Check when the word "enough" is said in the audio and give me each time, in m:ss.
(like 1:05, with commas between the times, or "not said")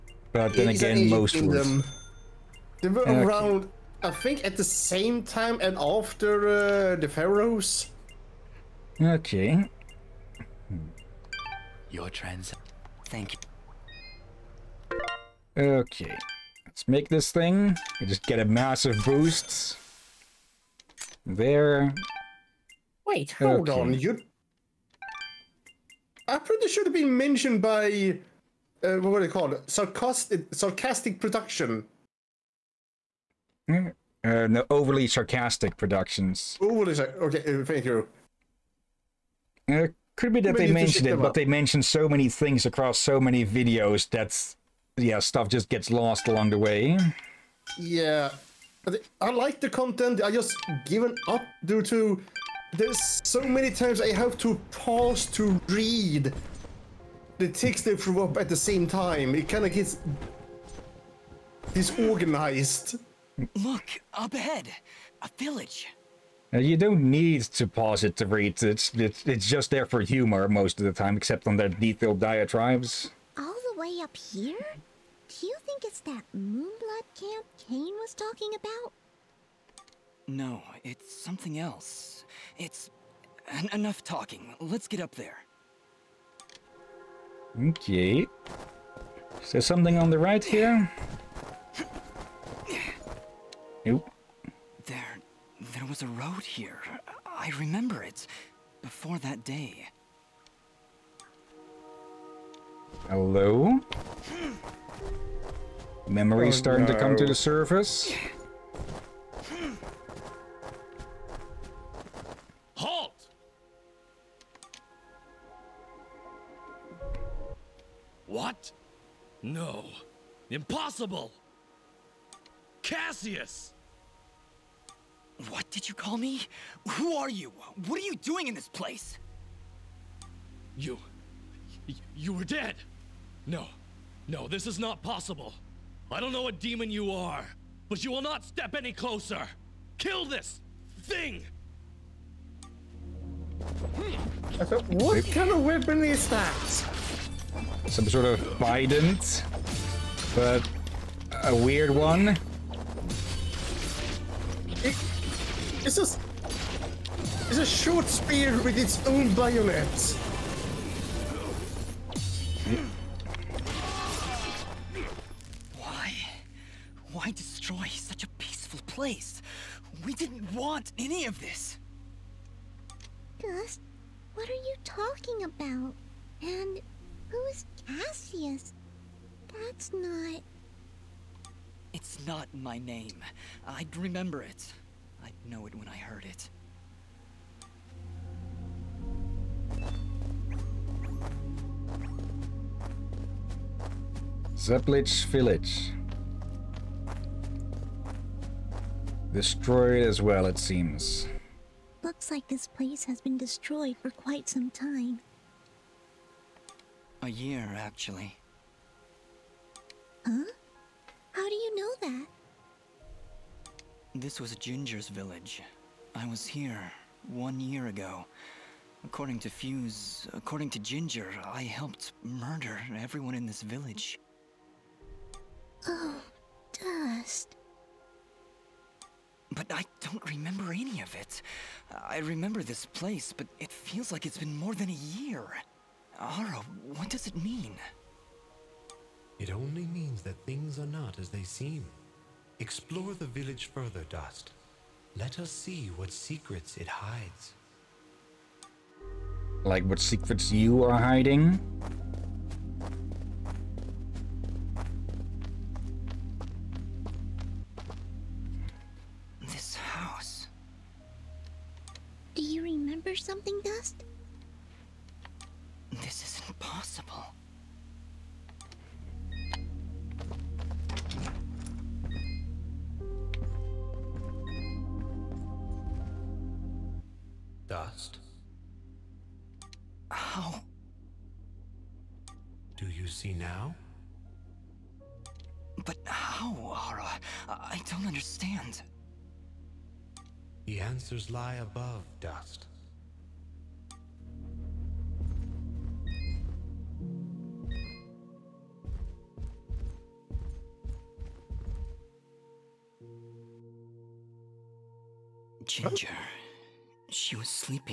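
1:23.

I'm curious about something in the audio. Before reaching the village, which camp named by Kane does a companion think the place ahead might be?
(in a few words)
Moonblood camp.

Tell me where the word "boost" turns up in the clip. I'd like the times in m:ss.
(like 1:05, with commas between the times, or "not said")
0:19.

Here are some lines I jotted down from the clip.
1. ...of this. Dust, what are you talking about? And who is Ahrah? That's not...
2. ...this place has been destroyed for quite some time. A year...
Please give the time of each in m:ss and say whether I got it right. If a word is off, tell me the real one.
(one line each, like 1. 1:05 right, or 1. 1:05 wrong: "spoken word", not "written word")
1. 2:51 wrong: "Cassius", not "Ahrah"
2. 3:22 right.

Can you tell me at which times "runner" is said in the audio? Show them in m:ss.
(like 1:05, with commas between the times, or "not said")
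not said.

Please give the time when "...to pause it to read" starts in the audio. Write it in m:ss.
1:07.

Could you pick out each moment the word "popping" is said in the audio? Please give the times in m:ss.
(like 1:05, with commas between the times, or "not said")
not said.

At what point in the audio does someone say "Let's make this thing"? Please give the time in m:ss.
0:16.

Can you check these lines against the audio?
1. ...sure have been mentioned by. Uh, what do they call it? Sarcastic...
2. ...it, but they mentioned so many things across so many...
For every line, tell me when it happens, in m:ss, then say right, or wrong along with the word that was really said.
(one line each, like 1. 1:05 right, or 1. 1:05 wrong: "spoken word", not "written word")
1. 0:26 right
2. 0:41 right.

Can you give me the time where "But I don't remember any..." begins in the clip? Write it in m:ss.
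3:49.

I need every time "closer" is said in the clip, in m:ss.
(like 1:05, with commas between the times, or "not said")
2:18.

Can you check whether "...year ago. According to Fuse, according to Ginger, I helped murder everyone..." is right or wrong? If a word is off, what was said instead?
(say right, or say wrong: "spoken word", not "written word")
right.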